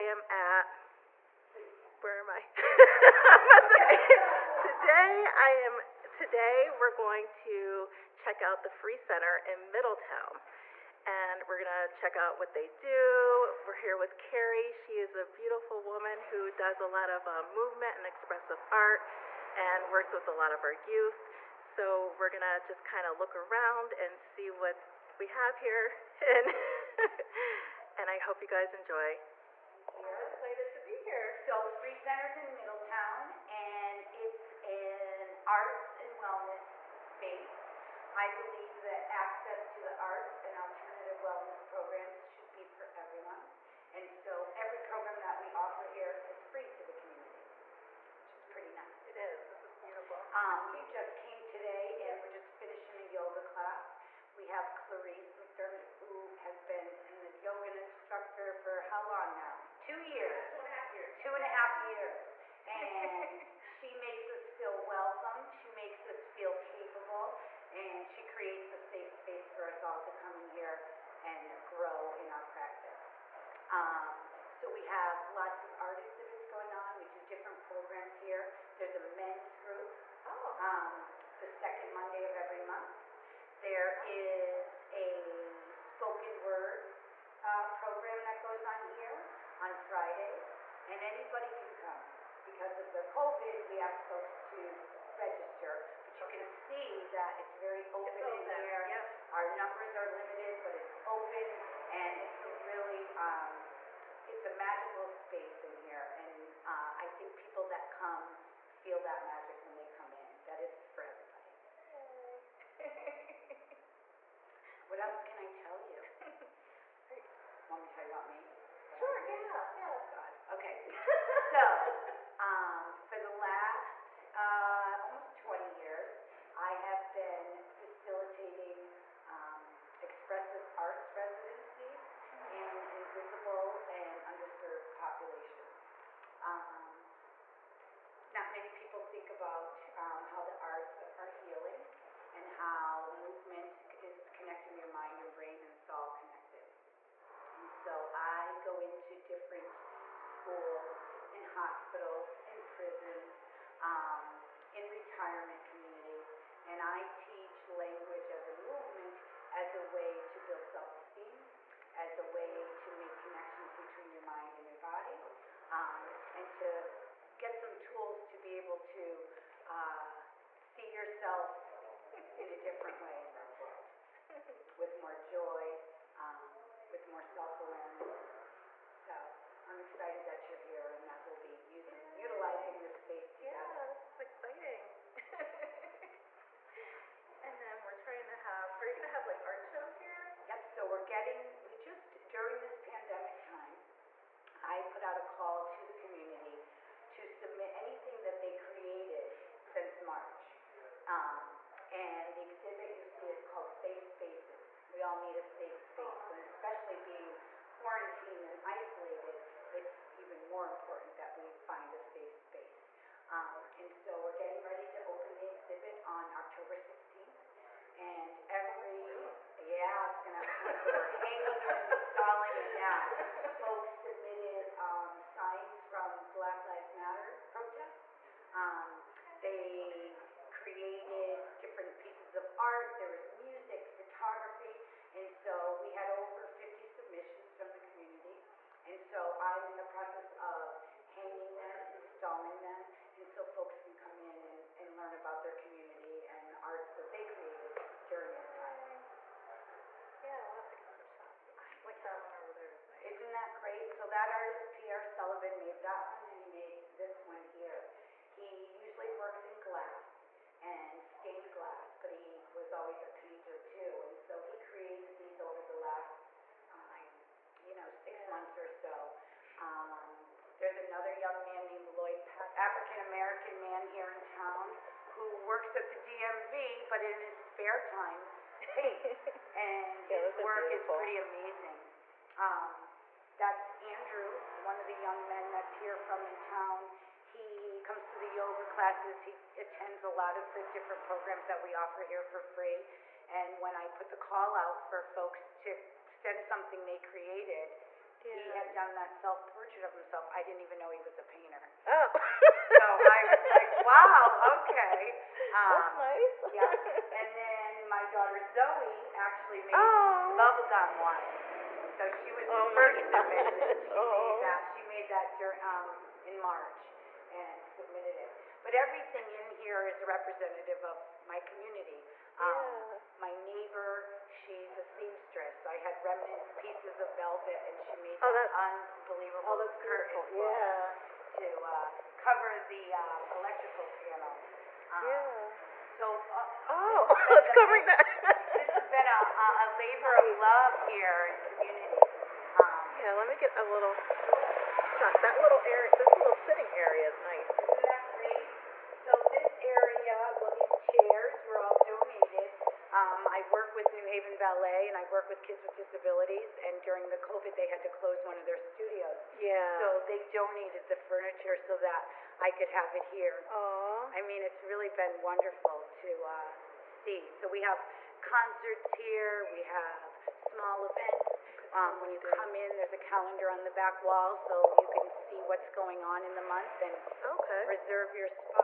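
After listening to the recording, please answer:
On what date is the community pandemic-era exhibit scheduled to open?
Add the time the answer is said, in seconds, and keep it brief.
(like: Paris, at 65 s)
October 16th, at 216 s.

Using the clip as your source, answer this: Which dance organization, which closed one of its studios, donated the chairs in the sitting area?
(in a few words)
New Haven Ballet.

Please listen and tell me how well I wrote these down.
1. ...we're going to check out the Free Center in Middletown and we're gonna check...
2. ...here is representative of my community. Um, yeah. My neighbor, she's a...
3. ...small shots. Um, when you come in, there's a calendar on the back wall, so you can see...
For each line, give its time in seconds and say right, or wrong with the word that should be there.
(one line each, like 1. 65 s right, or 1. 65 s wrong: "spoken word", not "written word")
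1. 6 s right
2. 319 s right
3. 370 s wrong: "events", not "shots".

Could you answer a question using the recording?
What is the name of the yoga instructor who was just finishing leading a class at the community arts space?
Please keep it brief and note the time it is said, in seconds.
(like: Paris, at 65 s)
Clarice McDermott, at 54 s.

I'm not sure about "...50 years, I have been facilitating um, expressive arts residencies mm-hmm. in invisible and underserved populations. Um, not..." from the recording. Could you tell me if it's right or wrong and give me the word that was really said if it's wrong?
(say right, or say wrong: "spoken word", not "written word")
wrong: "20", not "50".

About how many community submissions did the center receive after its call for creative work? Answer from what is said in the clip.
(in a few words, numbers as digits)
over 50.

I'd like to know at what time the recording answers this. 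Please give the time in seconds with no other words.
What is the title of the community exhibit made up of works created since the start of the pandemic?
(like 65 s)
203 s.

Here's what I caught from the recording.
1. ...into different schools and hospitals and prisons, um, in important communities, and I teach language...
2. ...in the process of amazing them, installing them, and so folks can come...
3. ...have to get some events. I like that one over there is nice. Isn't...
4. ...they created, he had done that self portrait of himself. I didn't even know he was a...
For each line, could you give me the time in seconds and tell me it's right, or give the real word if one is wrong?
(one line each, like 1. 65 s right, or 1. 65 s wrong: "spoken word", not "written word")
1. 148 s wrong: "retirement", not "important"
2. 239 s wrong: "hanging", not "amazing"
3. 250 s wrong: "shots", not "events"
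4. 296 s right.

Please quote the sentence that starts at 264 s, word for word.
And so he created these over the last, um, you know, six yeah.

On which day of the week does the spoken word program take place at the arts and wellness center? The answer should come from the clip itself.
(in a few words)
Fridays.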